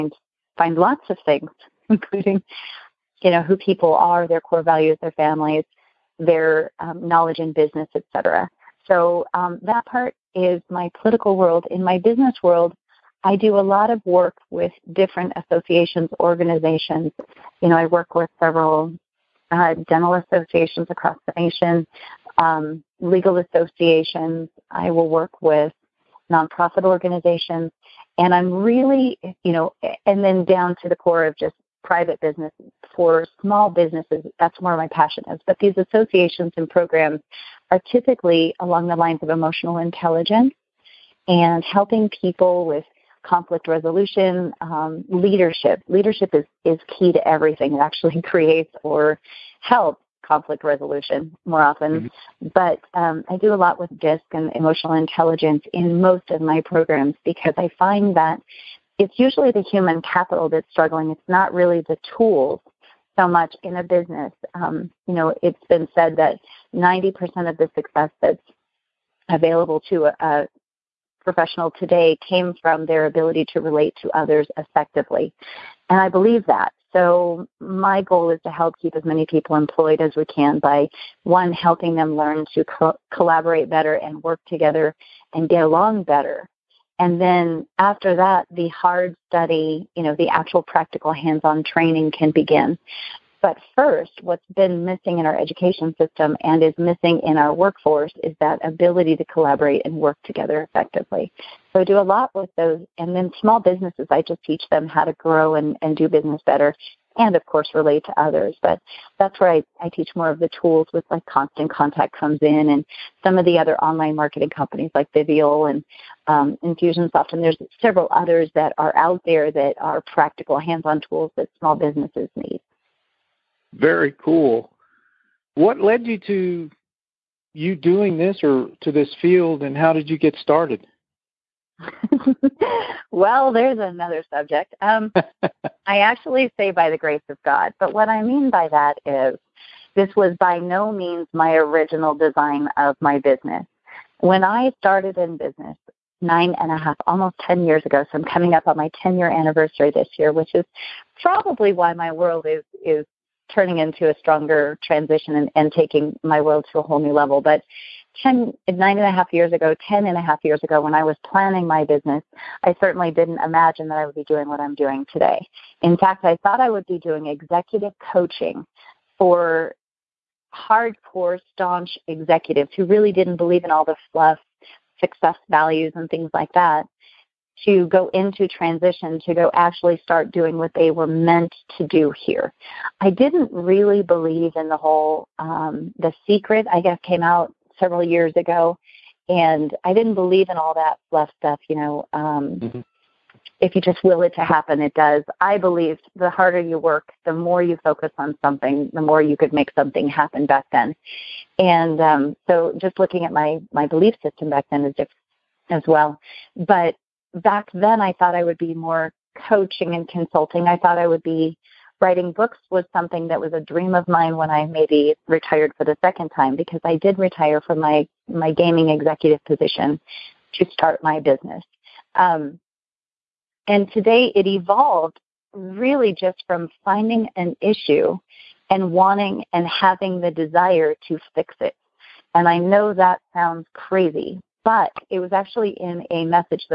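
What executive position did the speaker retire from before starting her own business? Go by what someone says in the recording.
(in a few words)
gaming executive.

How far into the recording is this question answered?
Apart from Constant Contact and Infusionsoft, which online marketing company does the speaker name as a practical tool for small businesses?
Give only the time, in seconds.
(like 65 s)
115 s.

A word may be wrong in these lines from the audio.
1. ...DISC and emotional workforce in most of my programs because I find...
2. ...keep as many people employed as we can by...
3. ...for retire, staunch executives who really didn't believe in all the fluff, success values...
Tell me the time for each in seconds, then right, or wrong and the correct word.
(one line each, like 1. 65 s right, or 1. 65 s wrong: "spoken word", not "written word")
1. 53 s wrong: "intelligence", not "workforce"
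2. 78 s right
3. 169 s wrong: "hardcore", not "retire".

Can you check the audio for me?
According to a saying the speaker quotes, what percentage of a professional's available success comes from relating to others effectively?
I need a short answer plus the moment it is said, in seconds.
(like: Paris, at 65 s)
90%, at 66 s.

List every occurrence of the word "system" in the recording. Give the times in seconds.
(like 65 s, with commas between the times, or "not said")
95 s, 204 s.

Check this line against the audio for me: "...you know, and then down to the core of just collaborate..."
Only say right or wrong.
wrong.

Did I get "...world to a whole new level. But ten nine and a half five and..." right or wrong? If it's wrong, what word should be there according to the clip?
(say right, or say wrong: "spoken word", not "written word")
wrong: "nine", not "five".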